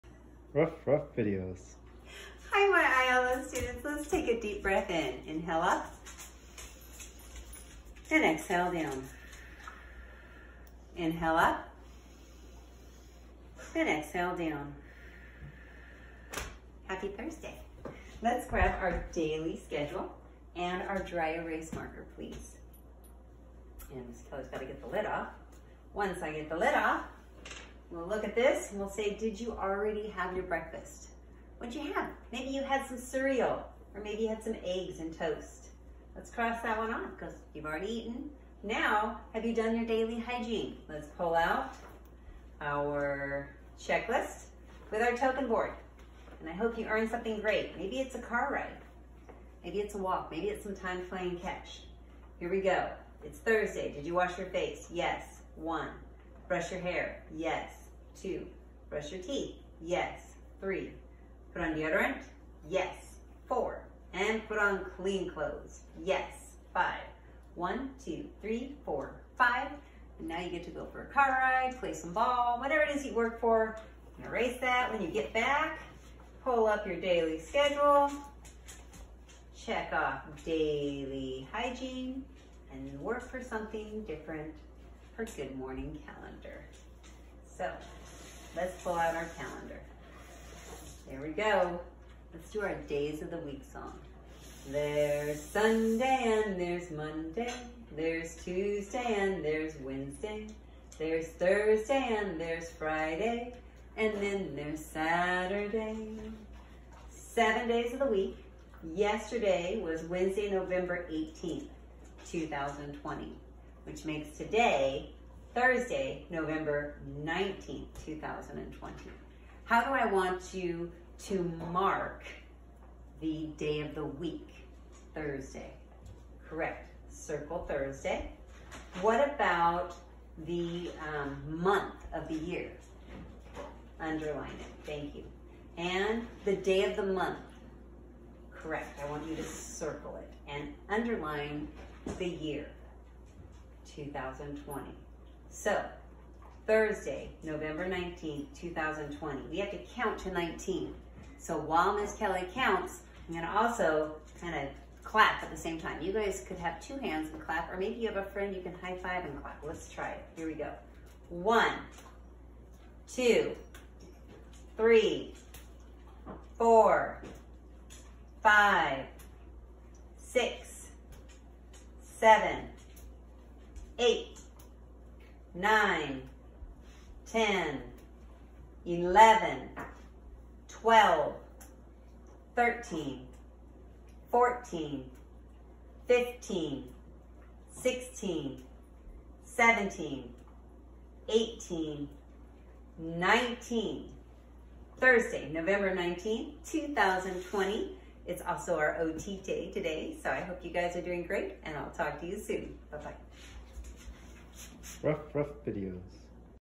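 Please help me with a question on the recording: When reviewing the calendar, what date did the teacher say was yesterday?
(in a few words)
Wednesday, November 18th, 2020.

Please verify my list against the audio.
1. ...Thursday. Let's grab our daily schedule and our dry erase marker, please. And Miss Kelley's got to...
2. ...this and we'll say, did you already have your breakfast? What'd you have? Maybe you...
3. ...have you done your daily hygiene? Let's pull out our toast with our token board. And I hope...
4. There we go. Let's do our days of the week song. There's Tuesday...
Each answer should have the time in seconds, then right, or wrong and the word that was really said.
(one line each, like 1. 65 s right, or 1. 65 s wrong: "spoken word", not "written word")
1. 17 s right
2. 28 s right
3. 39 s wrong: "checklist", not "toast"
4. 91 s wrong: "Sunday", not "Tuesday".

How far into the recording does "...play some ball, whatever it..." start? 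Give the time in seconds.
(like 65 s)
71 s.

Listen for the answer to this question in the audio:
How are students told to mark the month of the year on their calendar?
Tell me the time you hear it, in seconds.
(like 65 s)
133 s.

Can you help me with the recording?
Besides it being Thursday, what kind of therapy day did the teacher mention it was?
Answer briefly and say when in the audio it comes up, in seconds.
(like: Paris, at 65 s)
OT, at 199 s.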